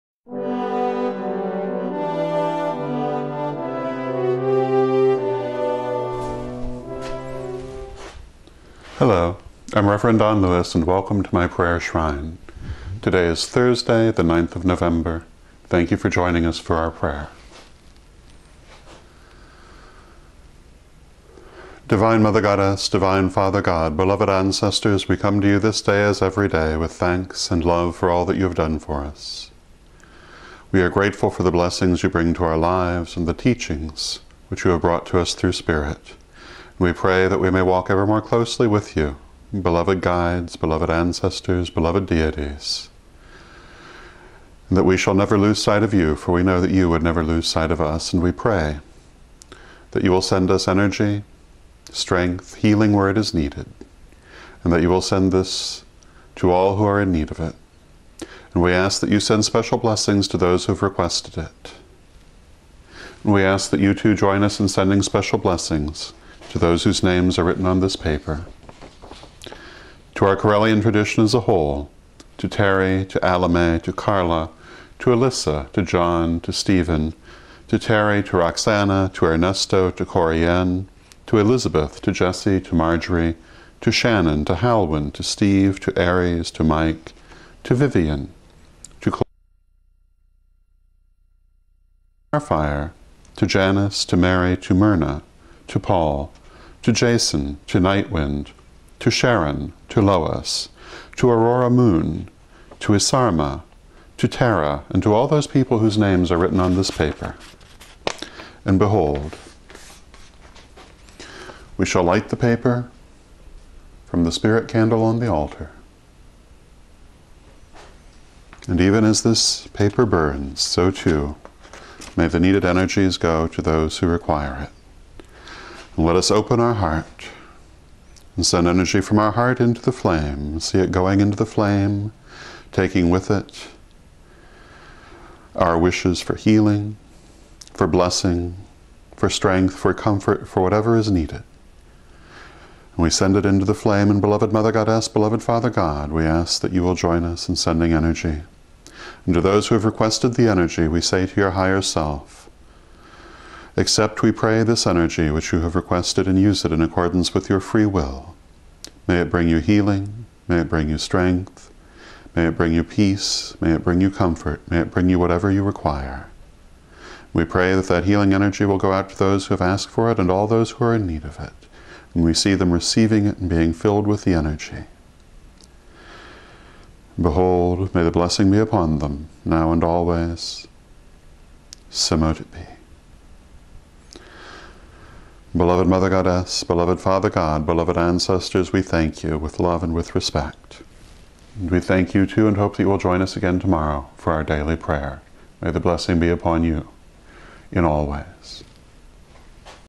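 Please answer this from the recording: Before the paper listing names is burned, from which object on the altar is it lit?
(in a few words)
the spirit candle.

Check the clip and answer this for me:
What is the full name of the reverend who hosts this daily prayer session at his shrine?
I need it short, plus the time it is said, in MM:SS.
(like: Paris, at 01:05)
Don Lewis, at 00:10.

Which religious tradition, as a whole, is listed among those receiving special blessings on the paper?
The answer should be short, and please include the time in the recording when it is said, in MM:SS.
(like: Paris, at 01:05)
Correllian, at 01:10.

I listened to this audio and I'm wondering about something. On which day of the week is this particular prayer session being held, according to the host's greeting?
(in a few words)
Thursday.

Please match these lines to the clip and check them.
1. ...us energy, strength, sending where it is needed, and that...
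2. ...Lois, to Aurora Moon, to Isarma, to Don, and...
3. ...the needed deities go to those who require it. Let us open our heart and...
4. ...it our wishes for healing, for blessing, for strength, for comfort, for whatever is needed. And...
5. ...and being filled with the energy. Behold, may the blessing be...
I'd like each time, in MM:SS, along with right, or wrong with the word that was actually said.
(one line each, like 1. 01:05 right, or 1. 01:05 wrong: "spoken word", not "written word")
1. 00:50 wrong: "healing", not "sending"
2. 01:40 wrong: "Tara", not "Don"
3. 02:02 wrong: "energies", not "deities"
4. 02:13 right
5. 02:53 right.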